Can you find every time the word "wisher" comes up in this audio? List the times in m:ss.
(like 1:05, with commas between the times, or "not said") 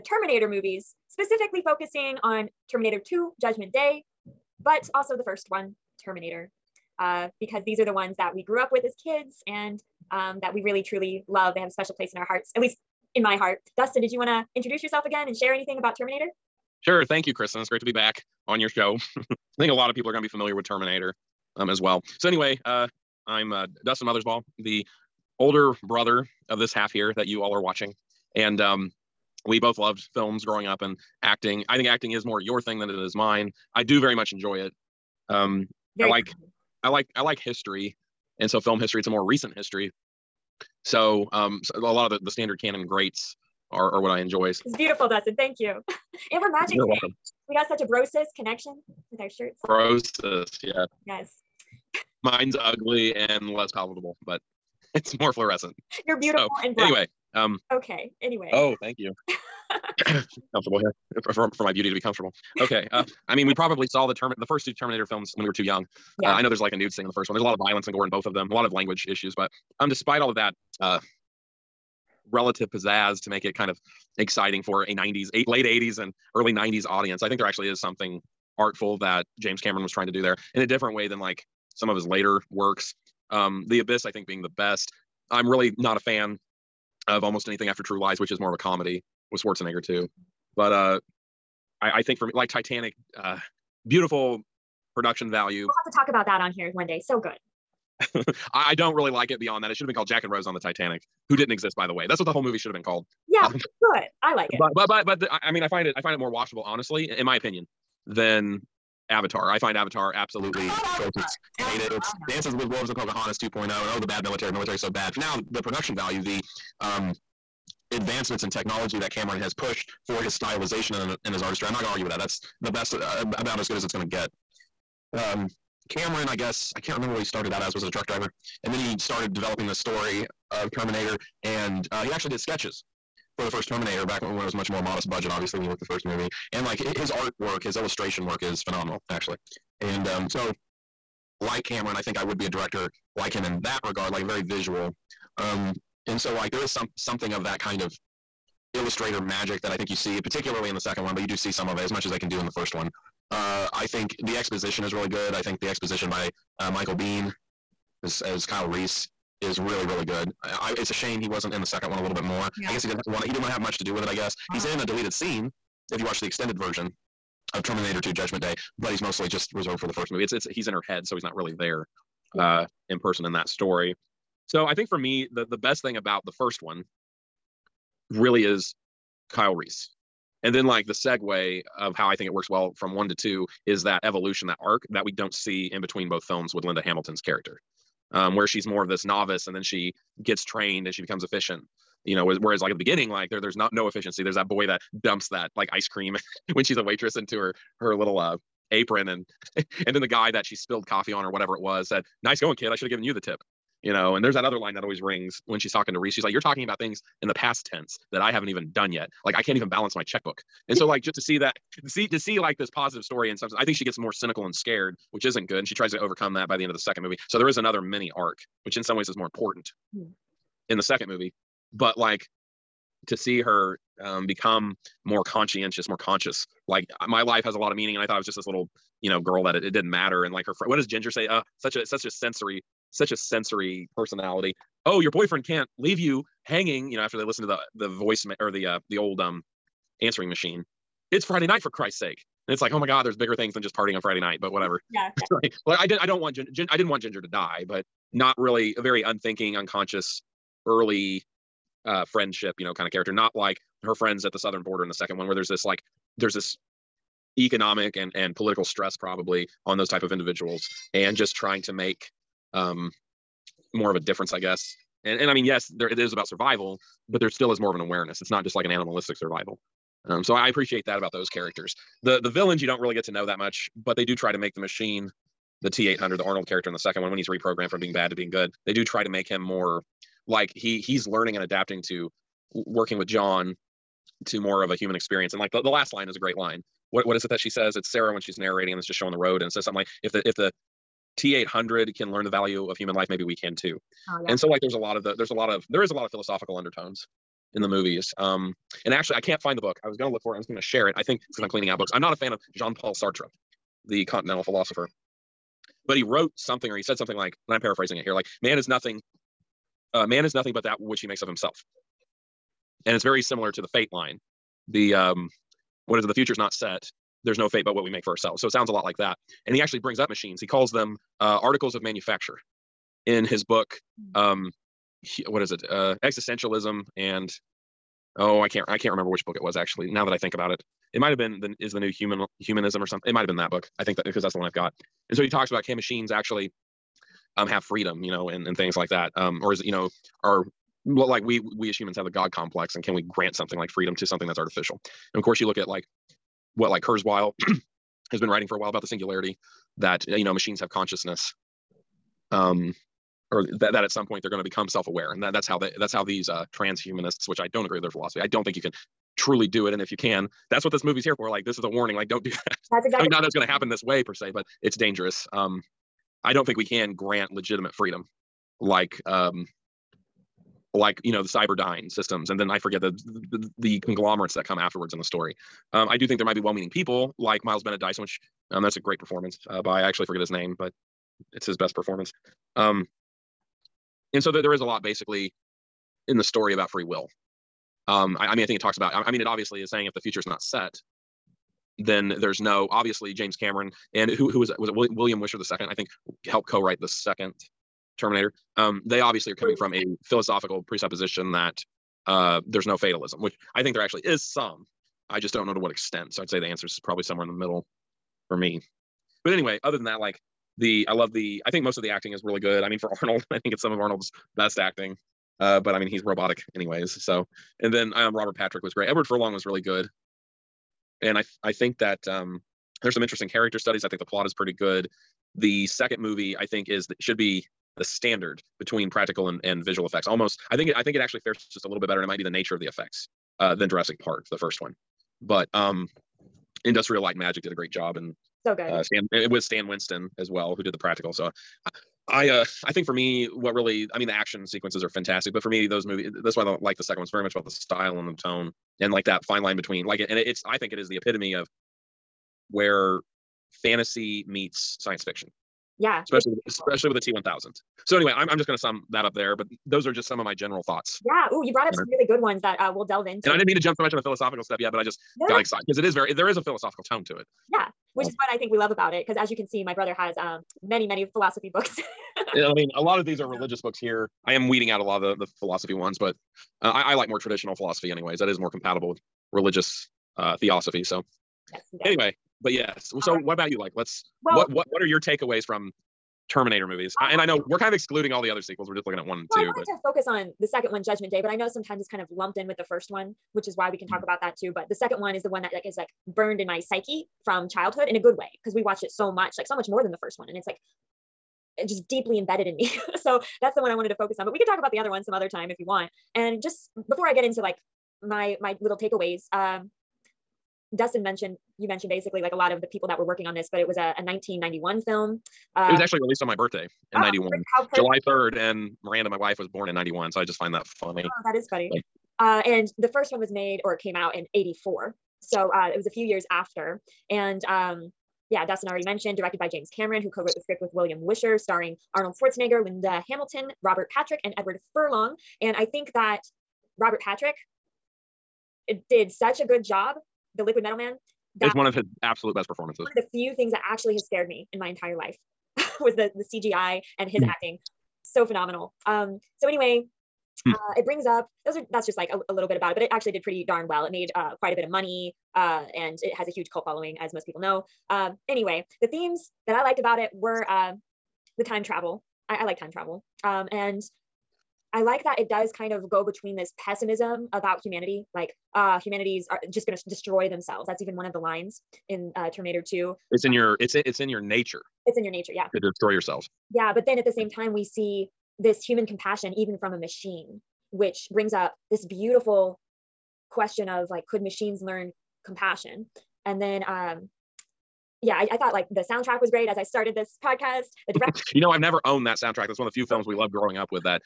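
6:35, 8:50.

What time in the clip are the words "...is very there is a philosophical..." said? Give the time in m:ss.
7:45.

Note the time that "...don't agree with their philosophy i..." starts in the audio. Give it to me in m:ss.
5:57.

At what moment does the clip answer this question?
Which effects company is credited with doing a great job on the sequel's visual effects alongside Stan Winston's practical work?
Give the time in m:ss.
7:16.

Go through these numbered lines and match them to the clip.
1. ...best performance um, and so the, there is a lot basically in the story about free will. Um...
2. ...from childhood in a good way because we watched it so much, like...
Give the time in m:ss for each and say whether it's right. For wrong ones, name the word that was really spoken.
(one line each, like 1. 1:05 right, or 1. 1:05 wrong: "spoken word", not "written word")
1. 6:21 right
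2. 8:17 right.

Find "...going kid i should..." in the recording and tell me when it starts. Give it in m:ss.
3:22.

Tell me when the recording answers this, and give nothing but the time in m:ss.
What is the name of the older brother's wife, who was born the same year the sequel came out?
8:38.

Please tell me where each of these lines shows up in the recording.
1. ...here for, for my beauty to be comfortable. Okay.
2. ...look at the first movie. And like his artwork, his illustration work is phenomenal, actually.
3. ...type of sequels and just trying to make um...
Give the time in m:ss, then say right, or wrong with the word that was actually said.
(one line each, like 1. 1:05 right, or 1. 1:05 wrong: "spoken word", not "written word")
1. 1:00 right
2. 2:15 right
3. 4:19 wrong: "individuals", not "sequels".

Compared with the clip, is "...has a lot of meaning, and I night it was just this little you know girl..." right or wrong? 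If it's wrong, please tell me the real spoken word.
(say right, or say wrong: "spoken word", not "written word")
wrong: "thought", not "night".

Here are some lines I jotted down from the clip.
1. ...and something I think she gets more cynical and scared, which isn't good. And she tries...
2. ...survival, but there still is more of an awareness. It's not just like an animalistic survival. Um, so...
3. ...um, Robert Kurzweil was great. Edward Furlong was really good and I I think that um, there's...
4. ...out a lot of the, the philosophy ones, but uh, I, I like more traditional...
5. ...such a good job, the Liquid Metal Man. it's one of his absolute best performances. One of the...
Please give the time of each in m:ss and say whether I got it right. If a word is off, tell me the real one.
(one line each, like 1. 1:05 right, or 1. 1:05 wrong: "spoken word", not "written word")
1. 3:33 right
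2. 4:26 right
3. 6:57 wrong: "Patrick", not "Kurzweil"
4. 7:54 right
5. 8:59 right.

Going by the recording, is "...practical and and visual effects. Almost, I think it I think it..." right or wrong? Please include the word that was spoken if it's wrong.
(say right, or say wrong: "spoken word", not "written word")
right.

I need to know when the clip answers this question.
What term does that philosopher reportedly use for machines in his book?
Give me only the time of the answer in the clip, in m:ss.
5:21.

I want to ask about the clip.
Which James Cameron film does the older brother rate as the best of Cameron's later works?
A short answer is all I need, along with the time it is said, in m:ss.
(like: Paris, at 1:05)
The Abyss, at 1:23.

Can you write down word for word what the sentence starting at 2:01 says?
I'm not going to argue with that.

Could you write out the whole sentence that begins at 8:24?
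But we could talk about the other one some other time if you want.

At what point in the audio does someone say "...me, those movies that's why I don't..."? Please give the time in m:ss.
7:25.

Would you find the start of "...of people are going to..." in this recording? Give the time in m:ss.
0:19.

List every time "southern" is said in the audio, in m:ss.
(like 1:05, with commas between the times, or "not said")
4:14.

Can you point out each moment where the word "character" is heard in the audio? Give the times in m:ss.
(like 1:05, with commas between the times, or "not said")
3:07, 4:12, 4:31, 4:36, 7:03.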